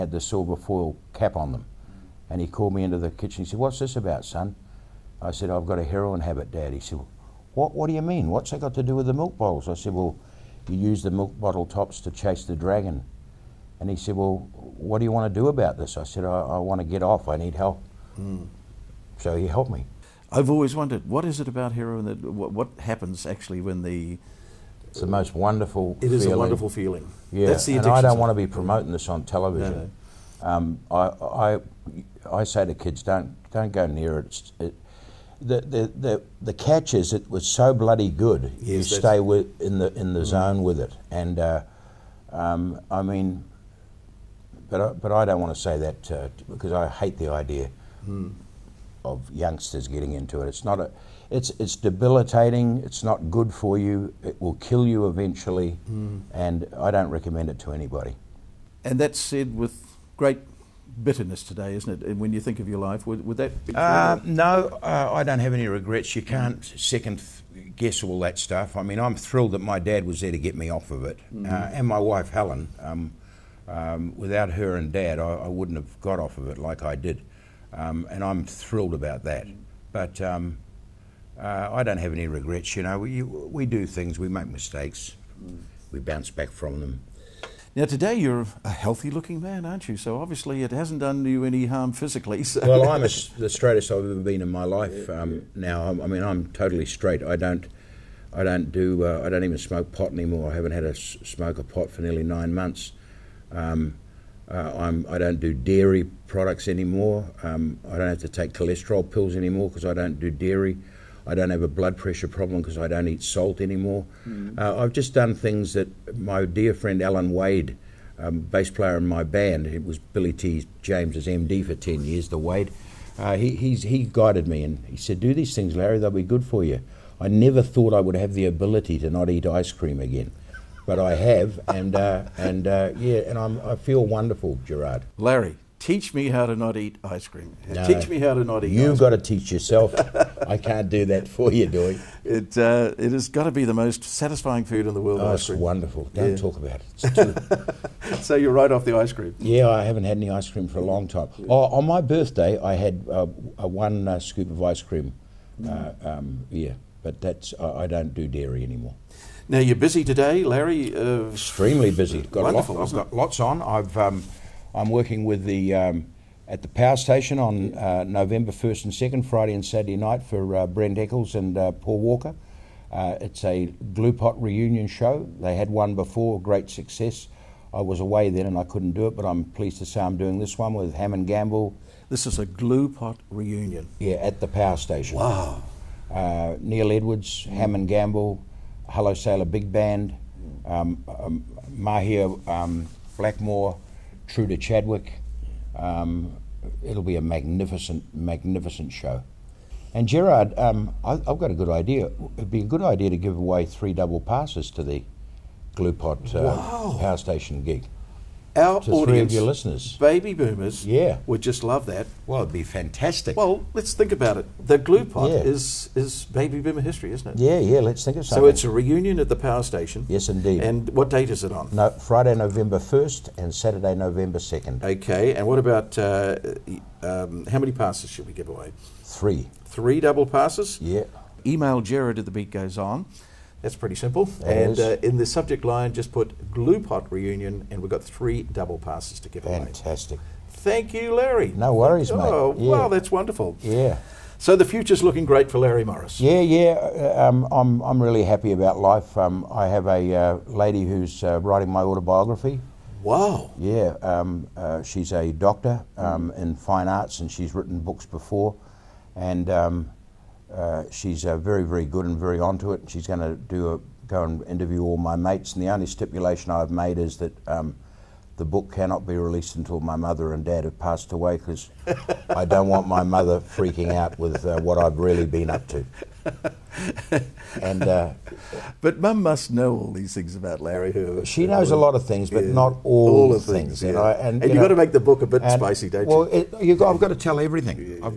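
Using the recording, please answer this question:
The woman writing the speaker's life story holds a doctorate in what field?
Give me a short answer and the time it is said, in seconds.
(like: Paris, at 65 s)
Fine arts, at 256 s.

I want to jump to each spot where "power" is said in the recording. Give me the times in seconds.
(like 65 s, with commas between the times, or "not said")
166 s, 184 s, 206 s, 219 s.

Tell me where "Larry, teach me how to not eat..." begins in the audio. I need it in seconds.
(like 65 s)
135 s.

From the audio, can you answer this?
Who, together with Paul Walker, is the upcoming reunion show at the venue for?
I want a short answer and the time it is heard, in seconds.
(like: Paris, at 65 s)
Brent Eccles, at 170 s.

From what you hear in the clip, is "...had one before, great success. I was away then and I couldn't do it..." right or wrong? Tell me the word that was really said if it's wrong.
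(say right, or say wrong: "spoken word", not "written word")
right.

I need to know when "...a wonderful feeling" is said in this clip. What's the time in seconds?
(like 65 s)
26 s.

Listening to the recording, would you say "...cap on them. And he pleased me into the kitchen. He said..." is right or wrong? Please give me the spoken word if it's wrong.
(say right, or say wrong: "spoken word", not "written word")
wrong: "called", not "pleased".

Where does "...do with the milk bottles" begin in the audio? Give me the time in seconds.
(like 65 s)
8 s.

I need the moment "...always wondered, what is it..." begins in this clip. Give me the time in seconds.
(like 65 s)
20 s.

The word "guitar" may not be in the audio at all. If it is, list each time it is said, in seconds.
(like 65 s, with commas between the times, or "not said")
not said.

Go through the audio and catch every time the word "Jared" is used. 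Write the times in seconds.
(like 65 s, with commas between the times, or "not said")
231 s.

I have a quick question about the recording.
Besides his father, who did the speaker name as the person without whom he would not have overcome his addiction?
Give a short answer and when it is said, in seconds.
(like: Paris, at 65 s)
Helen, at 72 s.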